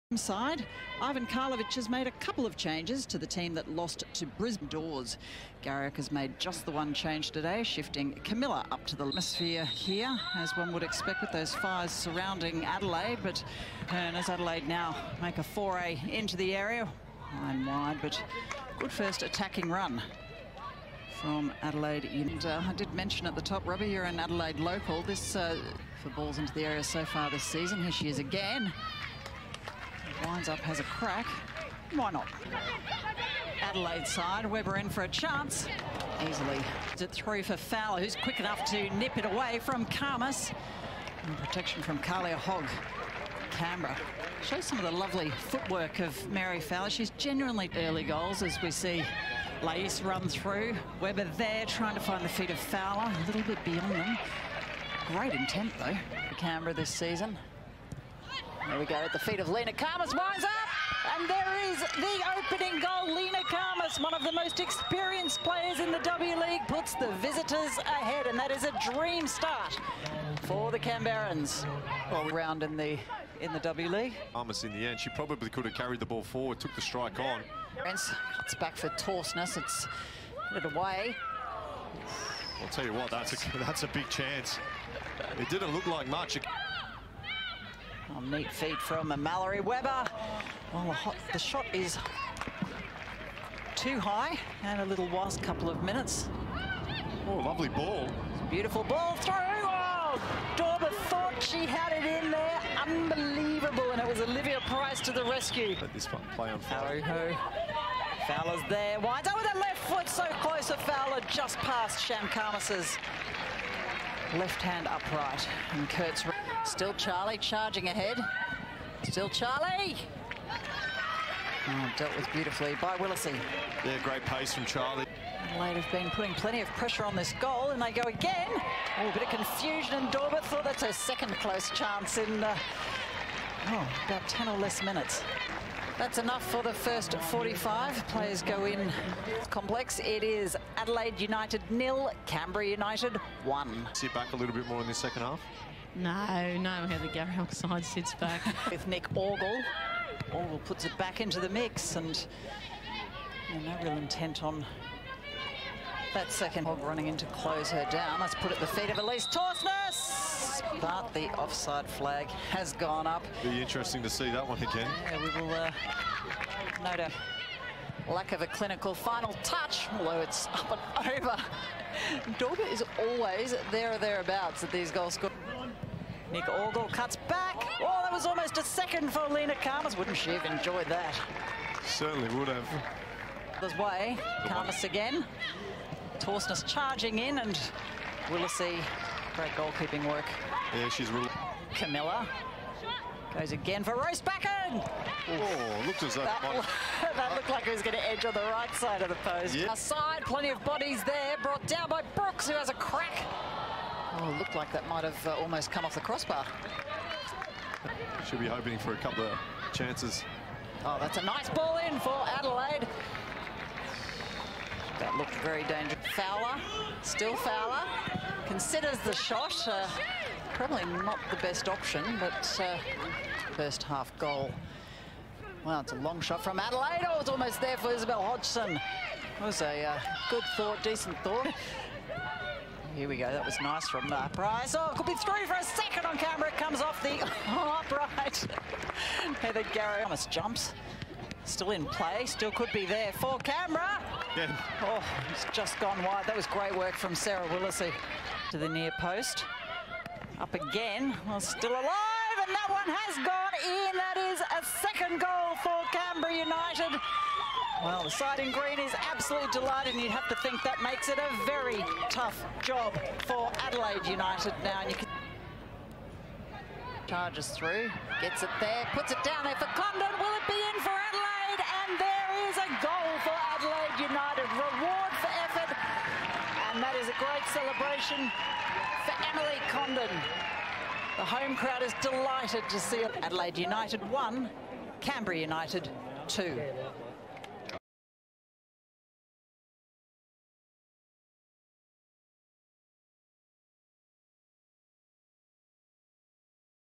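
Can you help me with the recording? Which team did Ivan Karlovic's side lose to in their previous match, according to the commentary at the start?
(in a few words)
Brisbane Roar.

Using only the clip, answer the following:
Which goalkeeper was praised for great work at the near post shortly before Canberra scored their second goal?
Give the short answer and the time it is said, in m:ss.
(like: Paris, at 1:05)
Sarah Willacy, at 4:07.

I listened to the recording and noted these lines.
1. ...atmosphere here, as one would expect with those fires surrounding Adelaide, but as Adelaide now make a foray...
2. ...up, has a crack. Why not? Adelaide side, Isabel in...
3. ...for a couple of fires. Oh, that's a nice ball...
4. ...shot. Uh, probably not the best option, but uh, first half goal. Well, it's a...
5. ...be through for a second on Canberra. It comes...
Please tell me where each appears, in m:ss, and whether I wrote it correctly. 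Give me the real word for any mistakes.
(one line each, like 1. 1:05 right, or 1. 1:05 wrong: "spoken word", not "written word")
1. 0:09 right
2. 0:30 wrong: "Weber", not "Isabel"
3. 3:28 wrong: "chances", not "fires"
4. 3:39 right
5. 3:55 right.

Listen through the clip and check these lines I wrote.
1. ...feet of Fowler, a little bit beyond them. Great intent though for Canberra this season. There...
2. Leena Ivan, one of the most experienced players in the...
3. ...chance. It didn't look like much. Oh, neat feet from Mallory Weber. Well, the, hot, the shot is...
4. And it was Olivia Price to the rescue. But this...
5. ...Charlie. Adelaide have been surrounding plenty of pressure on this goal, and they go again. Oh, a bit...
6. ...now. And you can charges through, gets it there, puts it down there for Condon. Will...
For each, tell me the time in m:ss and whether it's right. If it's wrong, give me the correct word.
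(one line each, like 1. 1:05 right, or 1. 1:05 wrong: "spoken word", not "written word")
1. 0:52 right
2. 1:03 wrong: "Khamis", not "Ivan"
3. 1:24 right
4. 1:43 right
5. 2:04 wrong: "putting", not "surrounding"
6. 4:24 right.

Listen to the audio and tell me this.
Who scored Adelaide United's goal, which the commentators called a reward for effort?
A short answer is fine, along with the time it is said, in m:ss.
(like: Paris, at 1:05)
Emily Condon, at 4:39.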